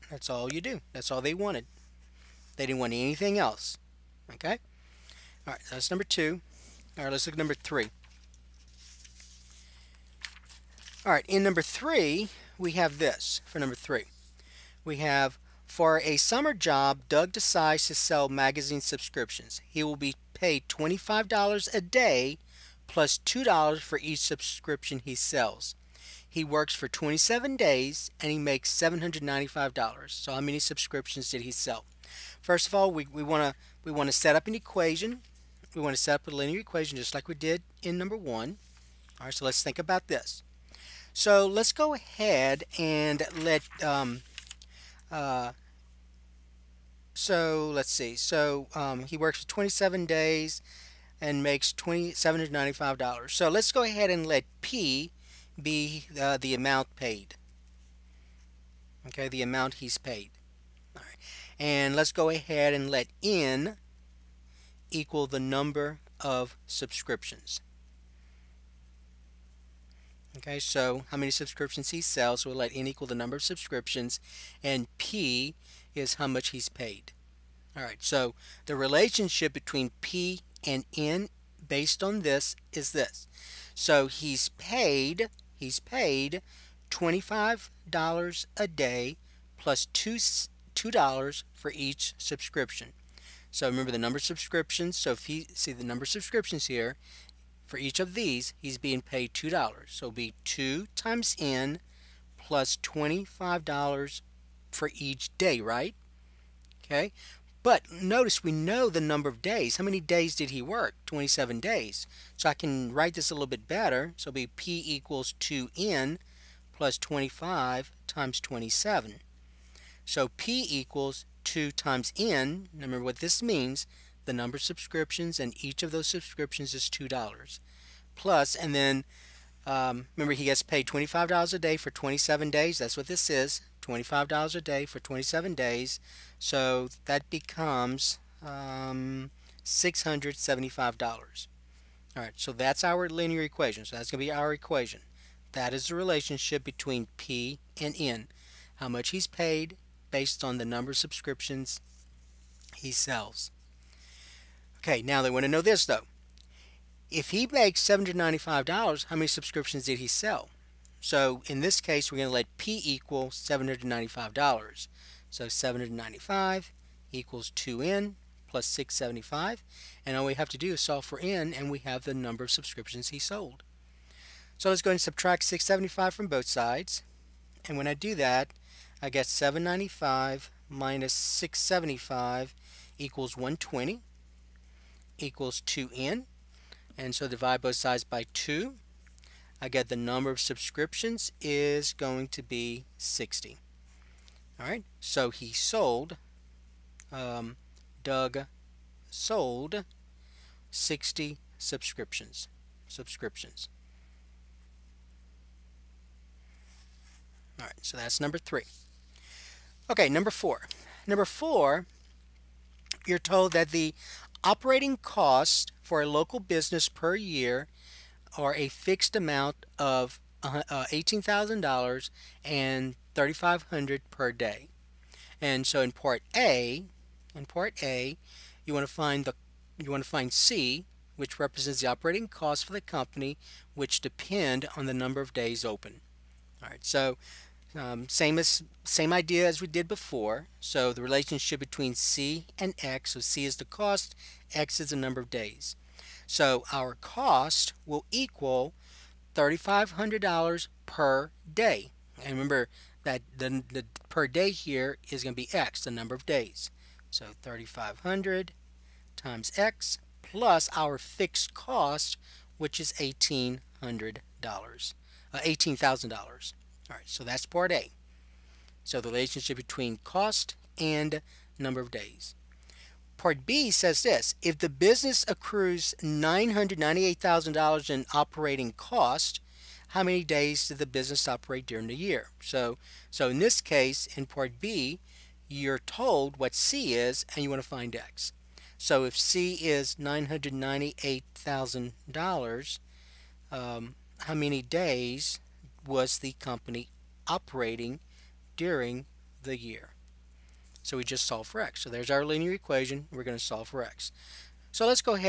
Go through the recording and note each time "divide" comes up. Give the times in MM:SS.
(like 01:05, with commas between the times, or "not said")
03:07.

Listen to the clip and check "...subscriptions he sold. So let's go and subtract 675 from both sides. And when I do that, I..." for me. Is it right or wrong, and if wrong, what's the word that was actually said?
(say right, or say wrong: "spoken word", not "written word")
right.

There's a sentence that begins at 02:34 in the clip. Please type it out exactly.
Okay, now they want to know this though.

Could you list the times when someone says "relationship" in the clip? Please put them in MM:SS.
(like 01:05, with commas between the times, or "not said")
01:18, 02:25, 04:01, 04:29.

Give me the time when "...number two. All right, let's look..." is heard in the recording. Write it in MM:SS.
00:05.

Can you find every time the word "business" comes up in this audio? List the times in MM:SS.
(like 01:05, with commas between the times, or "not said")
03:36, 04:34, 04:40.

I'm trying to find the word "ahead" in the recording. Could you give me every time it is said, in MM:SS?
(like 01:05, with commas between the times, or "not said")
00:41, 00:53, 01:02.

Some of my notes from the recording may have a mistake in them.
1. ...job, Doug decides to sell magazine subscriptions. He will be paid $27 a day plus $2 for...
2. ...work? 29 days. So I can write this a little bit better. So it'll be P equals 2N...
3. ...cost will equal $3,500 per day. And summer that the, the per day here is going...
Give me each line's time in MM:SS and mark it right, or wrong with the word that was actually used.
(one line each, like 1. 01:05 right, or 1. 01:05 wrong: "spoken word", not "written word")
1. 00:16 wrong: "25", not "27"
2. 01:50 wrong: "27", not "29"
3. 04:06 wrong: "remember", not "summer".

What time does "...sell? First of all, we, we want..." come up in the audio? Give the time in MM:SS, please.
00:31.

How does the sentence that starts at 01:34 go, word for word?
So if you see the number of subscriptions here, for each of these, he's being paid $2.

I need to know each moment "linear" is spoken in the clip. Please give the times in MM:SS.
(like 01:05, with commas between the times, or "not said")
00:36, 02:23, 05:02.